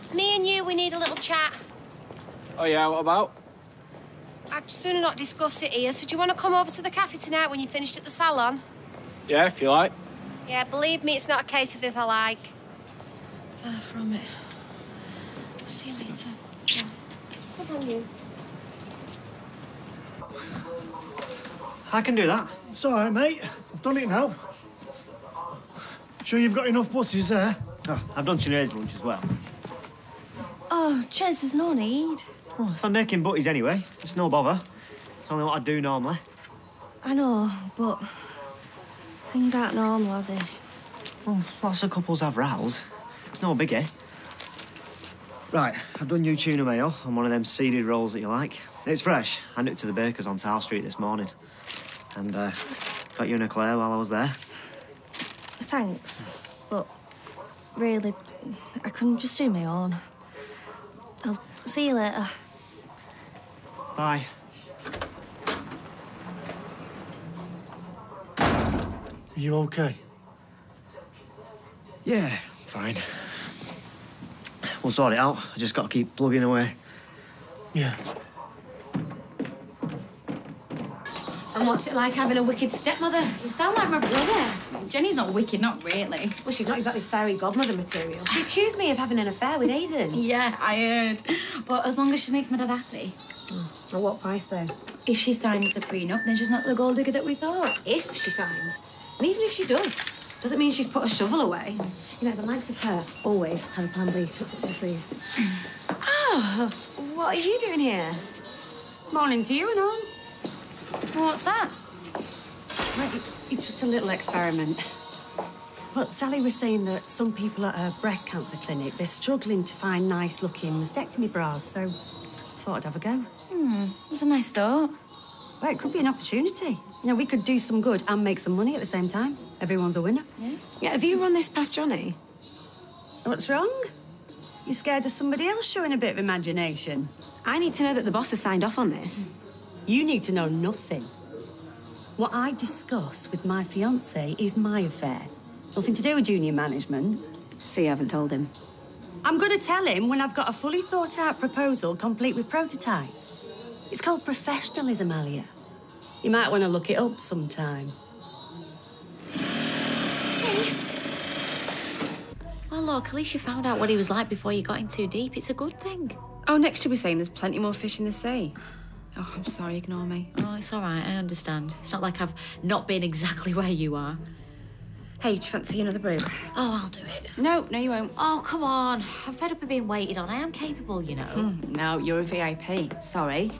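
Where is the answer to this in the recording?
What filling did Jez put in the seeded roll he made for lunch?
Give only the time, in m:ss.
0:46.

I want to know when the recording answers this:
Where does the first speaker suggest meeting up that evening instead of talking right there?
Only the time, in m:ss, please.
0:06.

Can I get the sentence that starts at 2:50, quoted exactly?
Oh, it's all right, I understand.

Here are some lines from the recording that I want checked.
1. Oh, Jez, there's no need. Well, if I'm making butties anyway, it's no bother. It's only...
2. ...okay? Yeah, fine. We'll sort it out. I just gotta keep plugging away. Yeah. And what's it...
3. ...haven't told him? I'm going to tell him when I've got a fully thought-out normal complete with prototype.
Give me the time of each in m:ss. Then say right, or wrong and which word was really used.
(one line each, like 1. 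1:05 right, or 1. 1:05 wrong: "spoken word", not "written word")
1. 0:30 right
2. 1:09 right
3. 2:27 wrong: "proposal", not "normal".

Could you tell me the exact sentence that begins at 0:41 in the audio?
Well, lots of couples have rows.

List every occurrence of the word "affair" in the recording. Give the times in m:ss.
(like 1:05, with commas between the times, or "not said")
1:29, 2:24.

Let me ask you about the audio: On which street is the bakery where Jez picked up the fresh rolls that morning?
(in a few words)
South Street.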